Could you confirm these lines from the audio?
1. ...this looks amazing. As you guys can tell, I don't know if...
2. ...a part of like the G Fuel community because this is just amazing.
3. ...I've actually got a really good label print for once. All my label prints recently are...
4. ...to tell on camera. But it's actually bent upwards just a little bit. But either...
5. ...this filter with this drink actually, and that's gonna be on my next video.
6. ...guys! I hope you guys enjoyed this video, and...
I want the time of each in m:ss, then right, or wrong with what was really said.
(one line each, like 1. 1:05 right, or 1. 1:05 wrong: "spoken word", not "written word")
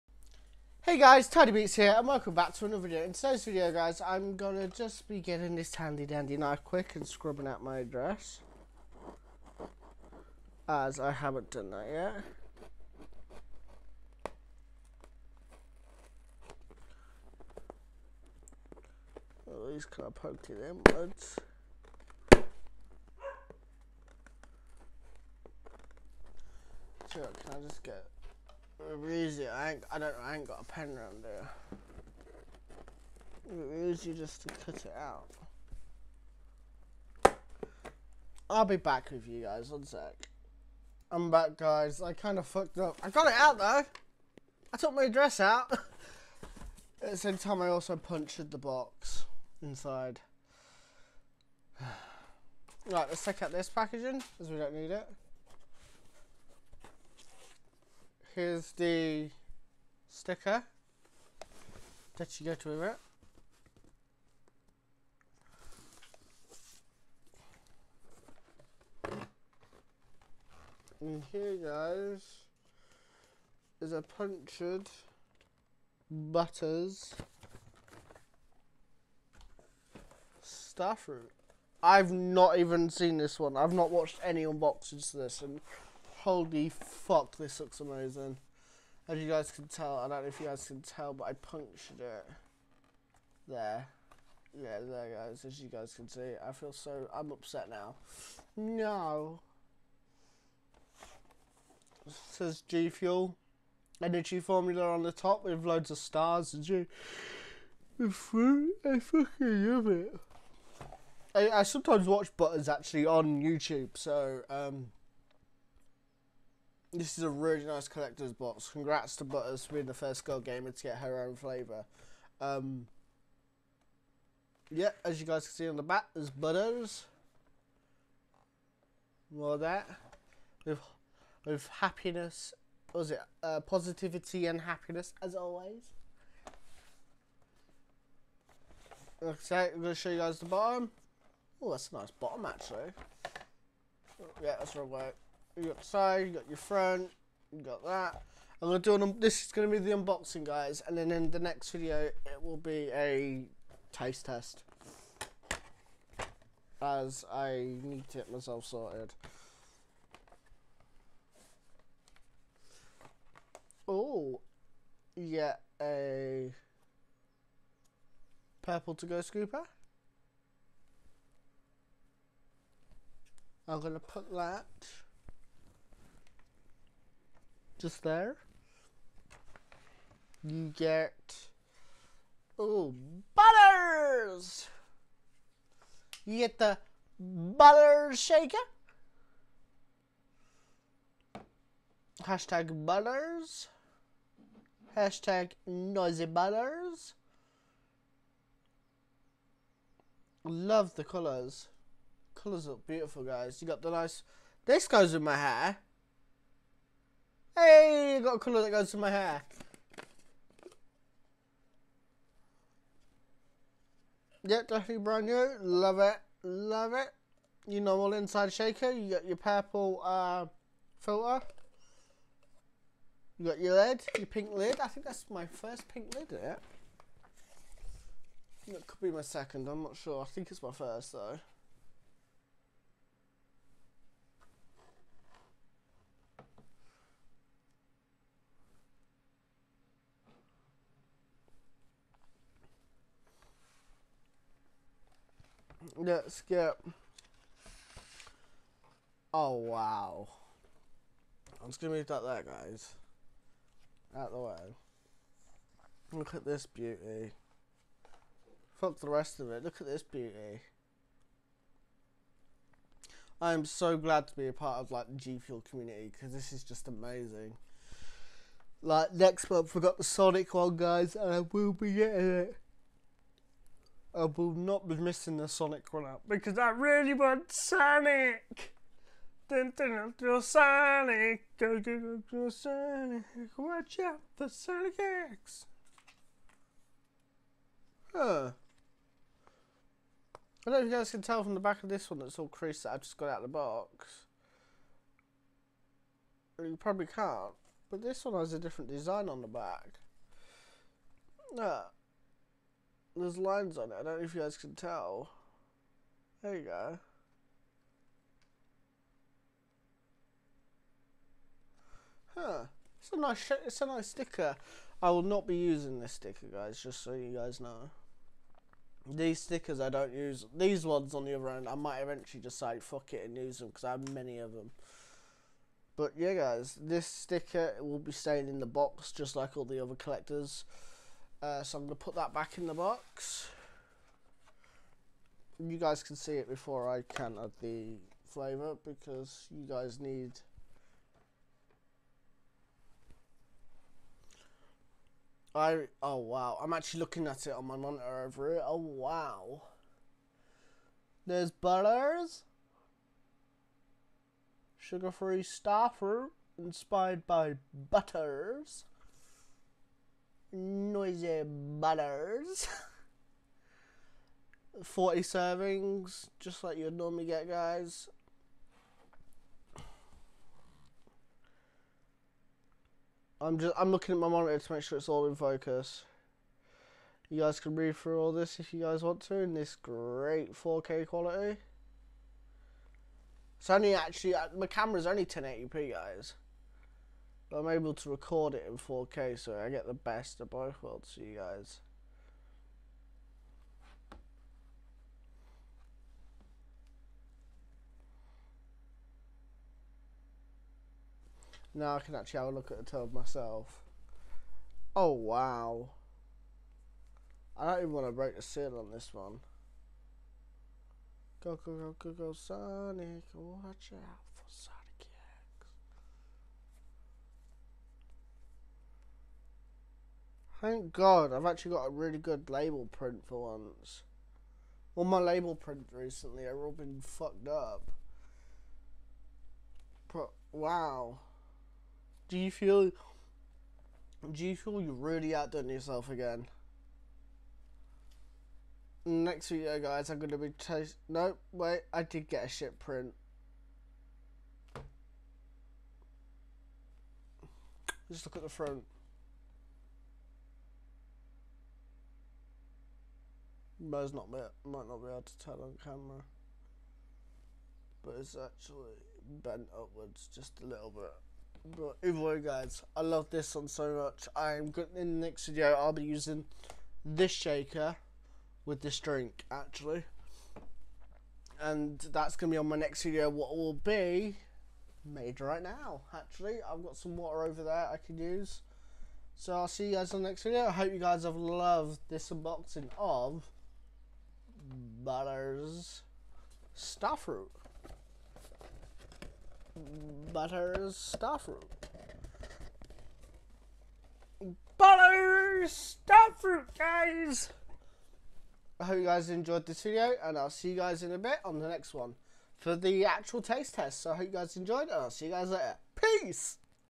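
1. 1:27 right
2. 4:24 right
3. 7:01 right
4. 7:35 right
5. 7:47 wrong: "shaker", not "filter"
6. 8:16 right.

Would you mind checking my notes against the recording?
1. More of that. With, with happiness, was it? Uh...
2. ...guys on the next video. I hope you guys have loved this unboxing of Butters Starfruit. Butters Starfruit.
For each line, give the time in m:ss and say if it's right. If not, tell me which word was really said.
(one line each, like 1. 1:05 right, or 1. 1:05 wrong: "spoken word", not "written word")
1. 2:09 right
2. 7:59 right.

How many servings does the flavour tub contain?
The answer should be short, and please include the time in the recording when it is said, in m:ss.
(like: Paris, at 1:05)
40, at 6:04.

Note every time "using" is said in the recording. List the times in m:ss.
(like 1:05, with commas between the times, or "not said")
5:15, 7:46.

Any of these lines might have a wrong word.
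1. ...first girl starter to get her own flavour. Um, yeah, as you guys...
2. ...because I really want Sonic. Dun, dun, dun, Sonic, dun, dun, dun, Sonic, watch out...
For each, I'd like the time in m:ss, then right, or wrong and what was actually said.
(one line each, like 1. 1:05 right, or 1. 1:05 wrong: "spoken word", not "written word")
1. 1:59 wrong: "gamer", not "starter"
2. 4:36 right.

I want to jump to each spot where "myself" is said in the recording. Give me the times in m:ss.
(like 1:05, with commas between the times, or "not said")
2:38, 6:43.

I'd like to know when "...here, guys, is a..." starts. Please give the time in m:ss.
1:11.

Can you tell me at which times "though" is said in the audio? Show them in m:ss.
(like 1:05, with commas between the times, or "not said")
0:43, 3:51.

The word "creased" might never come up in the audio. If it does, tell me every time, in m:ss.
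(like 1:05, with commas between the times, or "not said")
4:52.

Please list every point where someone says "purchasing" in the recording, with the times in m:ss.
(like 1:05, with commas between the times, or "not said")
not said.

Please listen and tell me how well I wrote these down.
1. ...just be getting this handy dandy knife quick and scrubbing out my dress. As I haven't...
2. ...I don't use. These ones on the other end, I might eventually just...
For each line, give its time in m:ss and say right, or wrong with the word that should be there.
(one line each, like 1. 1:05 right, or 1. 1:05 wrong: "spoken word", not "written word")
1. 0:04 wrong: "address", not "dress"
2. 5:19 right.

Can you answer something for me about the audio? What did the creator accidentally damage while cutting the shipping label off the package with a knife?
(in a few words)
The box inside.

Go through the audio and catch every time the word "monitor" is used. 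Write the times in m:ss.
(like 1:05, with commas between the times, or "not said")
5:47, 6:14.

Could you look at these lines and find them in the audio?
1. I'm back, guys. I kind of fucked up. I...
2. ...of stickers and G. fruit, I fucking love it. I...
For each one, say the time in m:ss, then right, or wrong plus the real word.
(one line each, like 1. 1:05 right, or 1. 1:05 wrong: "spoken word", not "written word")
1. 0:41 right
2. 1:45 wrong: "stars", not "stickers".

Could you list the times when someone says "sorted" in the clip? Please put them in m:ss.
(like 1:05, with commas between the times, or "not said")
2:38.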